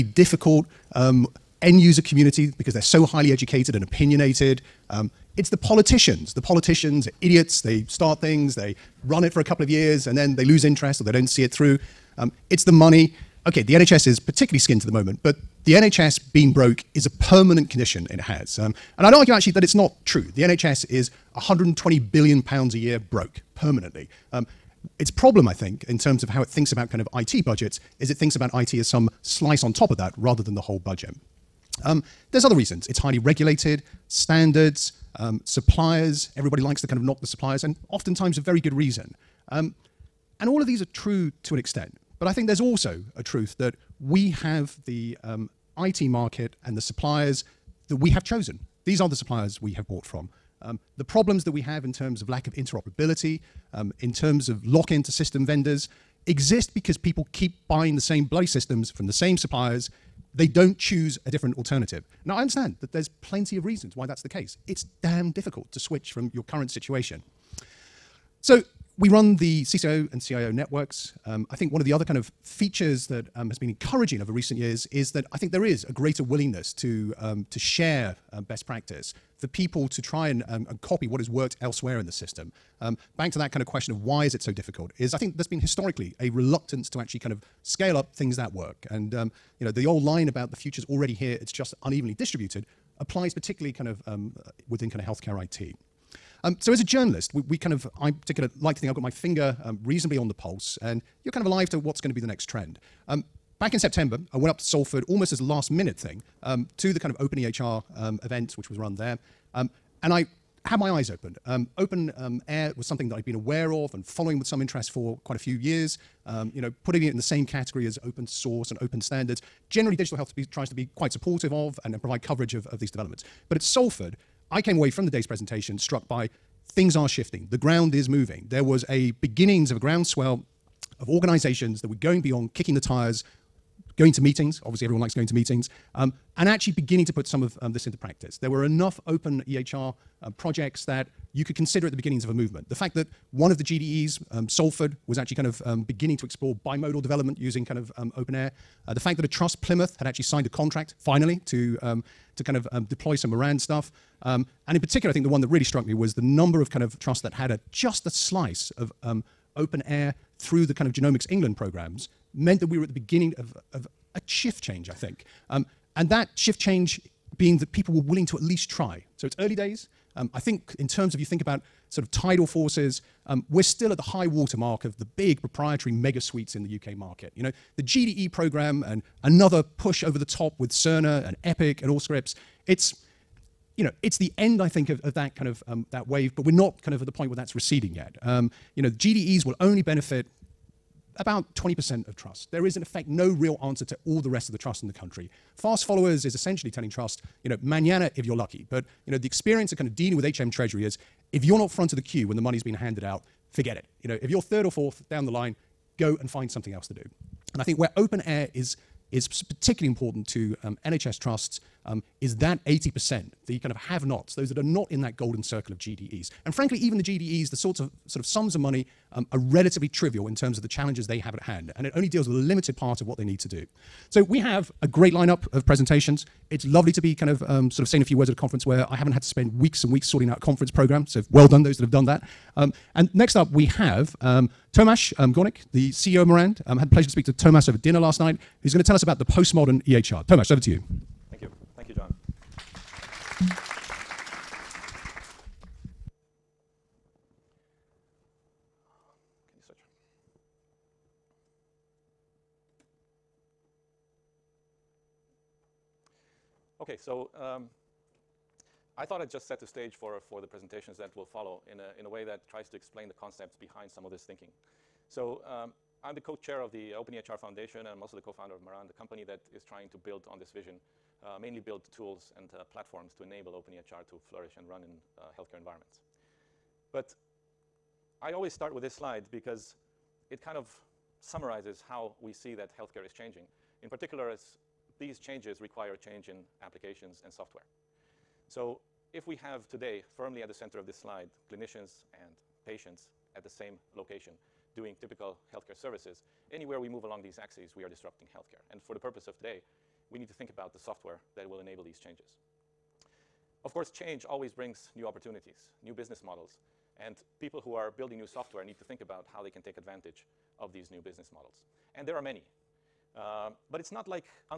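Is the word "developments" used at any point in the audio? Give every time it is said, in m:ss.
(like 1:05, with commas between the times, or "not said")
2:02, 2:27.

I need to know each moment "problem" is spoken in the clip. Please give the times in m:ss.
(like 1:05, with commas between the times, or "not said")
0:25, 0:51.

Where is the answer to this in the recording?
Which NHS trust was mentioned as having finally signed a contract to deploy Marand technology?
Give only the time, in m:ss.
2:29.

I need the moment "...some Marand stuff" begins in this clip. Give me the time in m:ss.
2:33.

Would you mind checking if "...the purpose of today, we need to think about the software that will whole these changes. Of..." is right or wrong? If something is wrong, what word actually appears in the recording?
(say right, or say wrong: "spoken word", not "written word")
wrong: "enable", not "whole".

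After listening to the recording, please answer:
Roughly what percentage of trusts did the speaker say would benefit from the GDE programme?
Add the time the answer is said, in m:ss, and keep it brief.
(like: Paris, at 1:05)
20%, at 3:11.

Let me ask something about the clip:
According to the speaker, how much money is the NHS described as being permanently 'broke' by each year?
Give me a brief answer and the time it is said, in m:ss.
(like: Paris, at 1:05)
120 billion pounds, at 0:21.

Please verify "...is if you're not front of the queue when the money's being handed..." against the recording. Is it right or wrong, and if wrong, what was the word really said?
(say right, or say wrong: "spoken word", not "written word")
right.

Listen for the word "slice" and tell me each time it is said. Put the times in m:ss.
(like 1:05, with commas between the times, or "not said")
0:29, 2:38.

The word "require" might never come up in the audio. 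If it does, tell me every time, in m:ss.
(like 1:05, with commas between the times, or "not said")
4:45.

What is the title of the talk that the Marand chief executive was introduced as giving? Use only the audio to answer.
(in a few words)
The postmodern EHR.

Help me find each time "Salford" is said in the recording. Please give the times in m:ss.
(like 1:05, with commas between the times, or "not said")
1:44, 2:03, 2:24.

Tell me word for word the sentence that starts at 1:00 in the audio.
They don't choose a different alternative.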